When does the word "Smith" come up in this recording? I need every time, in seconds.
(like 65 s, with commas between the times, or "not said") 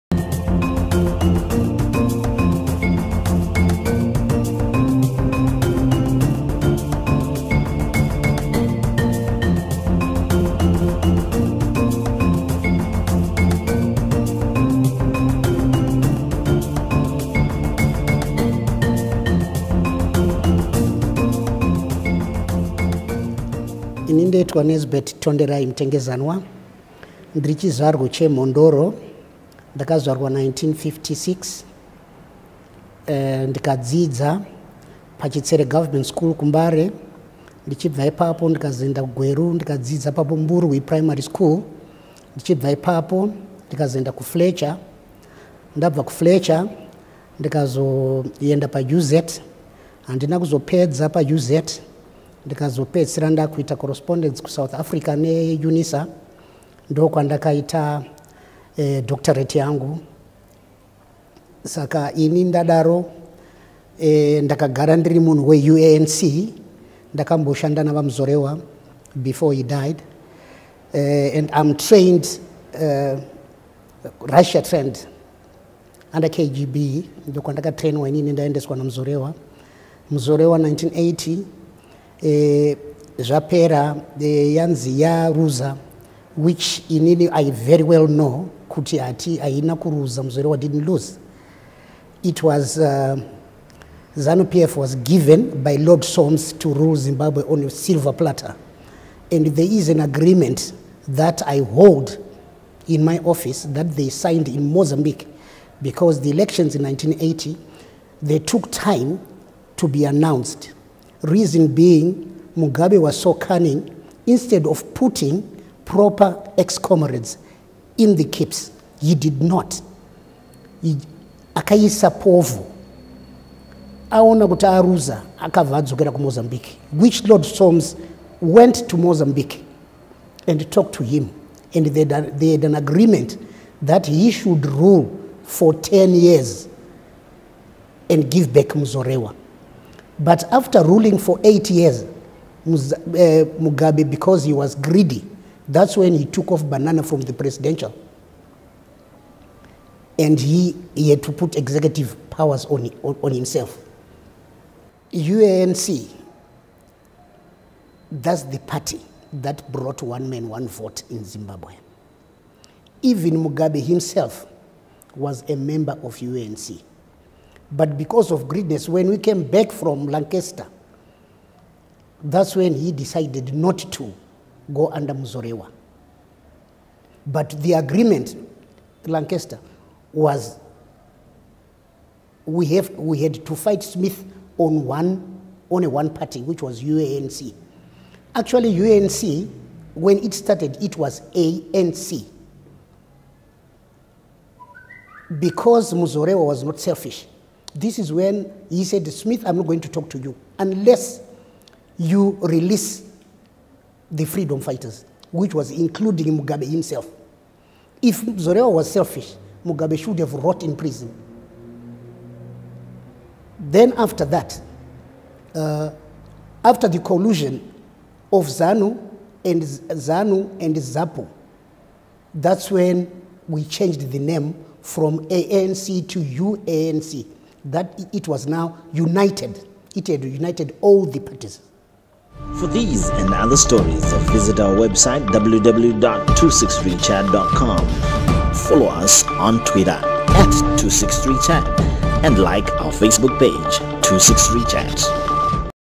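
183 s, 199 s.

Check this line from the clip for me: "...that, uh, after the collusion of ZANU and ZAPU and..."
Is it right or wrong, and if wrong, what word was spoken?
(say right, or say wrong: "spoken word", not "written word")
wrong: "ZANU", not "ZAPU".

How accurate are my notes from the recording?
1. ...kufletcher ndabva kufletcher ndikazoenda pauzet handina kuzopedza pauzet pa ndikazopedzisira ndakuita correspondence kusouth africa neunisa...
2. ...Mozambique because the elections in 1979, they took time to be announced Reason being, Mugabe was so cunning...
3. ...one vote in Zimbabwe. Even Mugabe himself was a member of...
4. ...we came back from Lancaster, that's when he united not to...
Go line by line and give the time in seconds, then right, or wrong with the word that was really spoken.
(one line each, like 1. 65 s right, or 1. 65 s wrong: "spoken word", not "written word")
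1. 44 s right
2. 104 s wrong: "1980", not "1979"
3. 160 s right
4. 169 s wrong: "decided", not "united".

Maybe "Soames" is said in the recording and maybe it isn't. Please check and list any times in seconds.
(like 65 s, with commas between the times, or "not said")
96 s, 127 s.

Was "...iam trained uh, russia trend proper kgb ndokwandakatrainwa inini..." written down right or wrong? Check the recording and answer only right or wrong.
wrong.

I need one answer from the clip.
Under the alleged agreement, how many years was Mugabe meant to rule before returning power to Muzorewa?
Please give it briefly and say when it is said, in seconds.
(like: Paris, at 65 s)
10, at 135 s.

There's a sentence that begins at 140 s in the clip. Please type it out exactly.
But after ruling for eight years, eh, Mugabe, because he was greedy, that's when he took off banana from the presidential.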